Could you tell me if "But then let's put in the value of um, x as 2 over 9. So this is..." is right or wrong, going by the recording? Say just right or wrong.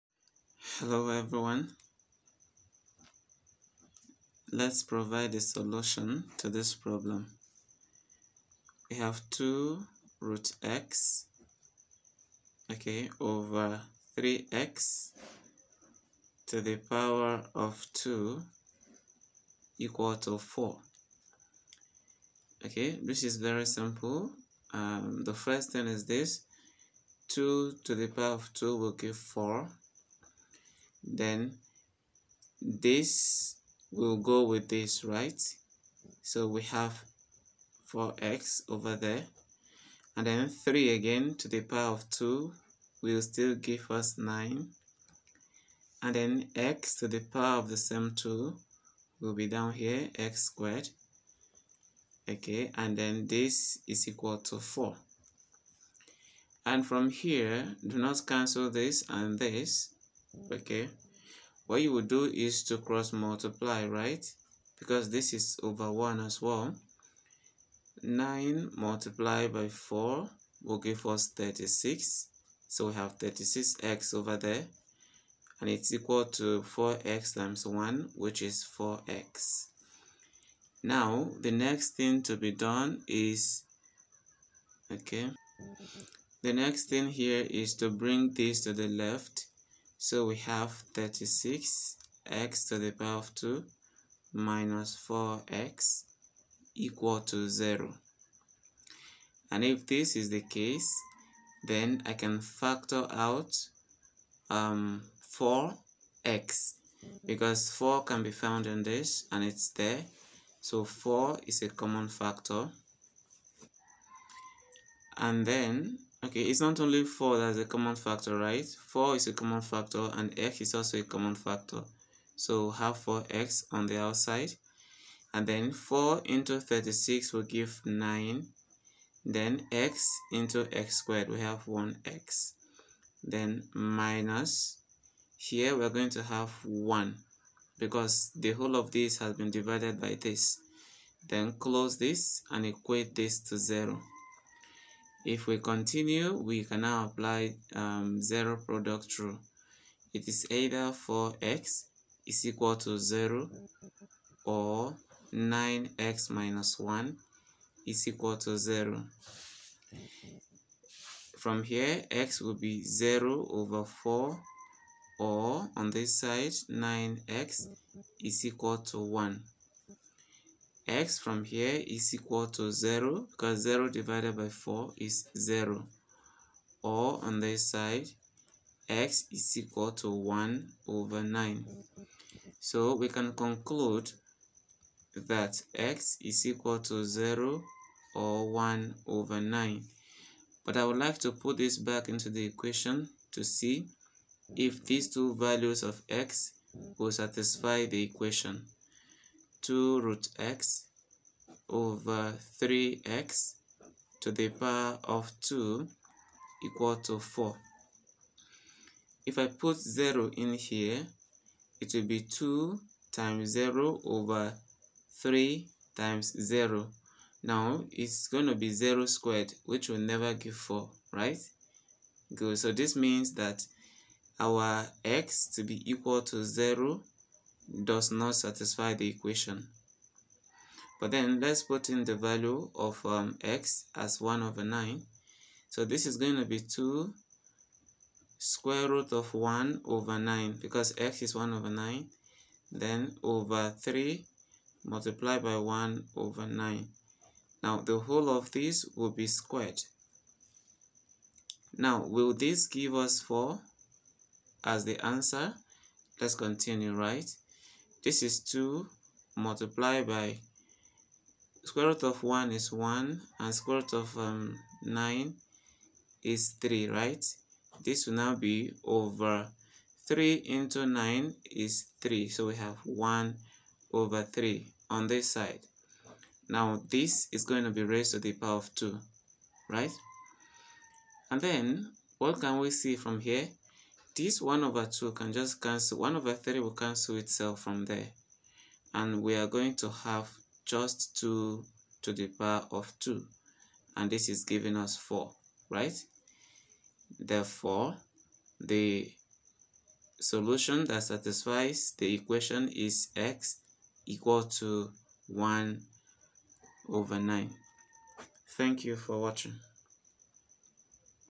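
wrong.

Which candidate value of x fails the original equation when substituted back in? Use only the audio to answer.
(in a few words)
0.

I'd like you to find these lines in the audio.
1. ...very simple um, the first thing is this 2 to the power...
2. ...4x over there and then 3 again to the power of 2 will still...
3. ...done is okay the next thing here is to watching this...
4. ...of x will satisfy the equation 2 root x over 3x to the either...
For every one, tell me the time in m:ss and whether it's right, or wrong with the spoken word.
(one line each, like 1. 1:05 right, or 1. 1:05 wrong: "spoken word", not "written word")
1. 0:23 right
2. 0:37 right
3. 1:22 wrong: "bring", not "watching"
4. 3:15 wrong: "power", not "either".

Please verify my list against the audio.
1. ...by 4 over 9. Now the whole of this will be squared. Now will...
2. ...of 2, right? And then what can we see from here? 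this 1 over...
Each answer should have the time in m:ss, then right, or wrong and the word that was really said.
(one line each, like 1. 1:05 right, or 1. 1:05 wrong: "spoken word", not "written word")
1. 4:05 wrong: "1", not "4"
2. 4:38 right.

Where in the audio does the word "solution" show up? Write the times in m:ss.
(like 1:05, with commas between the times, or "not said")
0:05, 5:00.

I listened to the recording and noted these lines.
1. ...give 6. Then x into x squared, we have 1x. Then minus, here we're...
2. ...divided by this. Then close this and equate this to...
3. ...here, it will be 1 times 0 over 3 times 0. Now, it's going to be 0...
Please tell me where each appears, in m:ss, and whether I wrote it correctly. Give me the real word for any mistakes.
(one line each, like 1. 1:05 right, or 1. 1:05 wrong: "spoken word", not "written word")
1. 2:07 wrong: "9", not "6"
2. 2:19 right
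3. 3:30 wrong: "2", not "1".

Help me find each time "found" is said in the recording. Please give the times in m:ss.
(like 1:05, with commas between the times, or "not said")
1:48.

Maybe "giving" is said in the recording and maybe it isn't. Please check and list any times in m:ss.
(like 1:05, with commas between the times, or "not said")
4:54.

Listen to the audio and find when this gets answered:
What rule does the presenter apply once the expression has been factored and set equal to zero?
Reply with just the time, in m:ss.
2:28.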